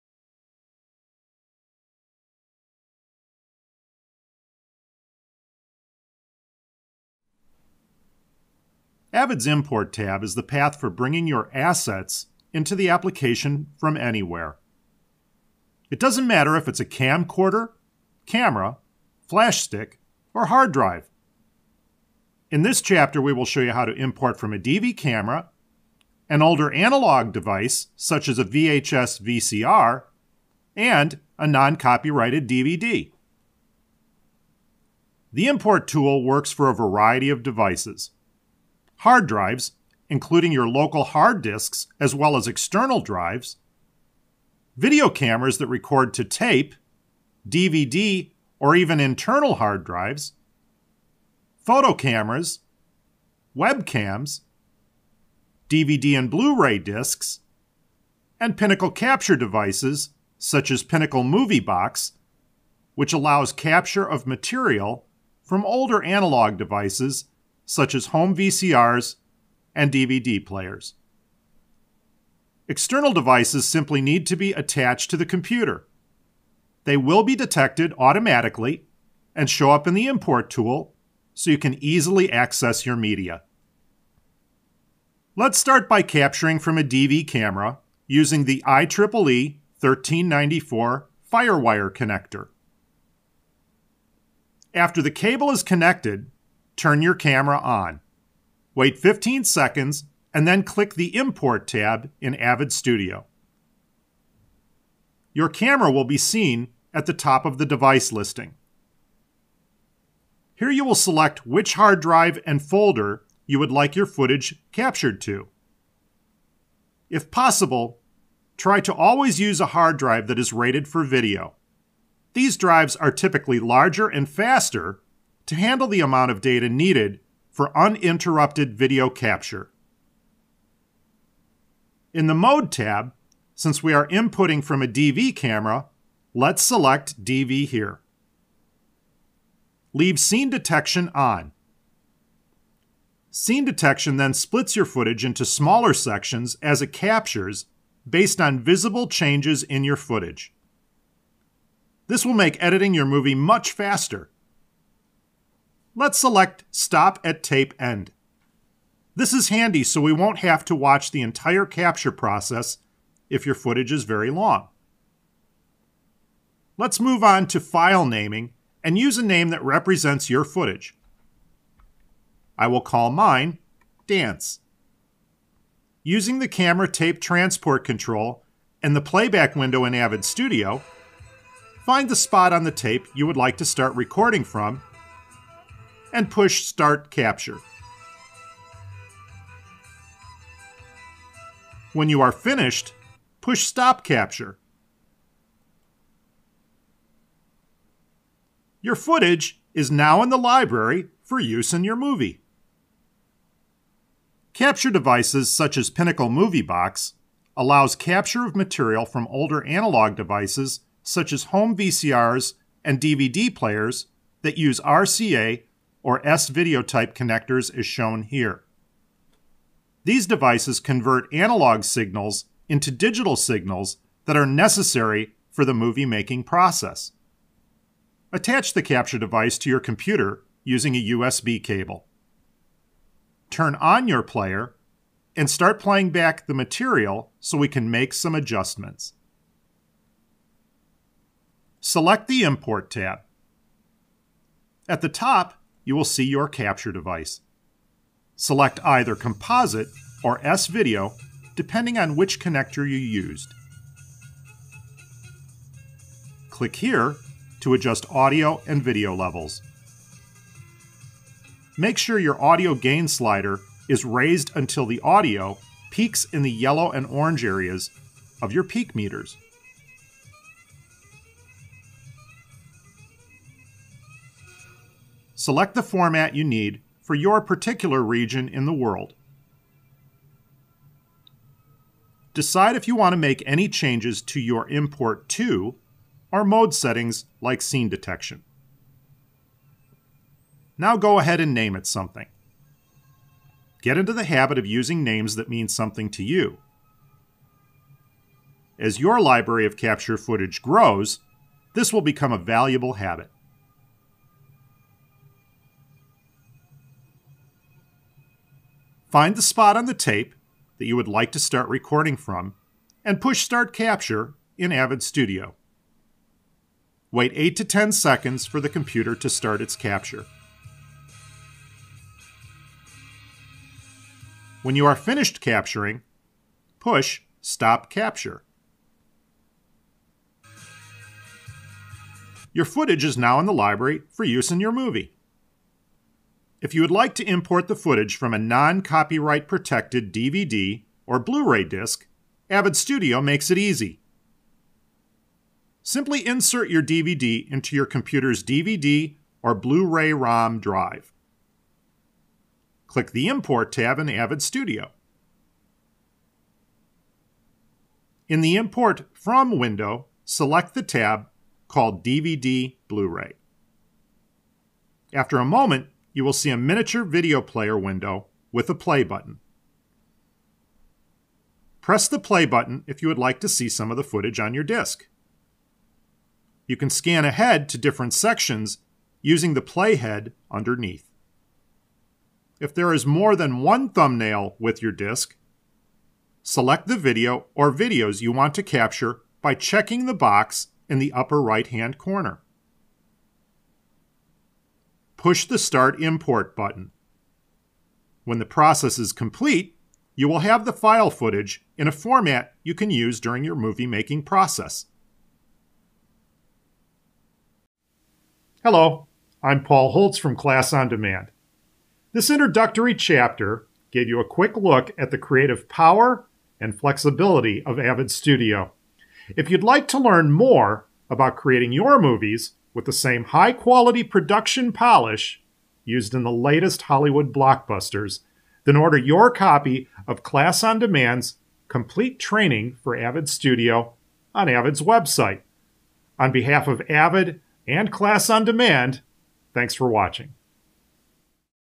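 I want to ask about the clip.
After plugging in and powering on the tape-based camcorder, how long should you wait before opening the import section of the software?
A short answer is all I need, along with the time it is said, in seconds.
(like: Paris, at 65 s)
15 seconds, at 98 s.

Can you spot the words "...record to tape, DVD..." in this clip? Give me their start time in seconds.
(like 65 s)
45 s.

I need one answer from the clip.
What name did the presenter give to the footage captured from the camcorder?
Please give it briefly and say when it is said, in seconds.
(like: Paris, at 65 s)
Dance, at 174 s.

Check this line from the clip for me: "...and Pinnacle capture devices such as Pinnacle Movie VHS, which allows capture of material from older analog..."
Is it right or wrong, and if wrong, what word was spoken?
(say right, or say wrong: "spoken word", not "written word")
wrong: "Box", not "VHS".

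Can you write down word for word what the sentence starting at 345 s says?
Simply insert your DVD into your computer's DVD or Blu ray ROM drive.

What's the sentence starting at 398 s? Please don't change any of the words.
When the process is complete, you will have the file footage in a format you can use during your movie making process.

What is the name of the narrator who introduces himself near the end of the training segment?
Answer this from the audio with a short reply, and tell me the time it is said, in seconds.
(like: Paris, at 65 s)
Paul Holtz, at 409 s.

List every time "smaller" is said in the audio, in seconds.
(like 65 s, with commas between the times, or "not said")
145 s.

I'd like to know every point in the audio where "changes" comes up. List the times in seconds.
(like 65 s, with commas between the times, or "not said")
149 s, 283 s.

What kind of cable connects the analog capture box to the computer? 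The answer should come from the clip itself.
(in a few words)
USB.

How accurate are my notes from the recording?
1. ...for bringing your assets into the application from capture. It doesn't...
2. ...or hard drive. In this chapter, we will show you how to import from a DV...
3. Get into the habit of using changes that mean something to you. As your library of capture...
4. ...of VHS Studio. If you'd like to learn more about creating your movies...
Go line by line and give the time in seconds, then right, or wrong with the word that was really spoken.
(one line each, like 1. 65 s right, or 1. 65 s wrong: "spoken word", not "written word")
1. 10 s wrong: "anywhere", not "capture"
2. 20 s right
3. 293 s wrong: "names", not "changes"
4. 417 s wrong: "Avid", not "VHS".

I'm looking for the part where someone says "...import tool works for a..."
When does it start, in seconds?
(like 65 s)
35 s.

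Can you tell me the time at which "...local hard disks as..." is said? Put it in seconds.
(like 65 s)
40 s.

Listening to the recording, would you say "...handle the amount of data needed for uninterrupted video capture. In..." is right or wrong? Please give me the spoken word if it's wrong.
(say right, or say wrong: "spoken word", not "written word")
right.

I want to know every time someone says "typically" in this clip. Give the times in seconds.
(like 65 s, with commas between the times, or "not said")
123 s.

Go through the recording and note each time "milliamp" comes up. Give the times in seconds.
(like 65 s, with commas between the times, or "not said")
not said.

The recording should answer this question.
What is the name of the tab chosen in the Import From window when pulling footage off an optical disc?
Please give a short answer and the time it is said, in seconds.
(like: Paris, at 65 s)
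DVD Blu ray, at 362 s.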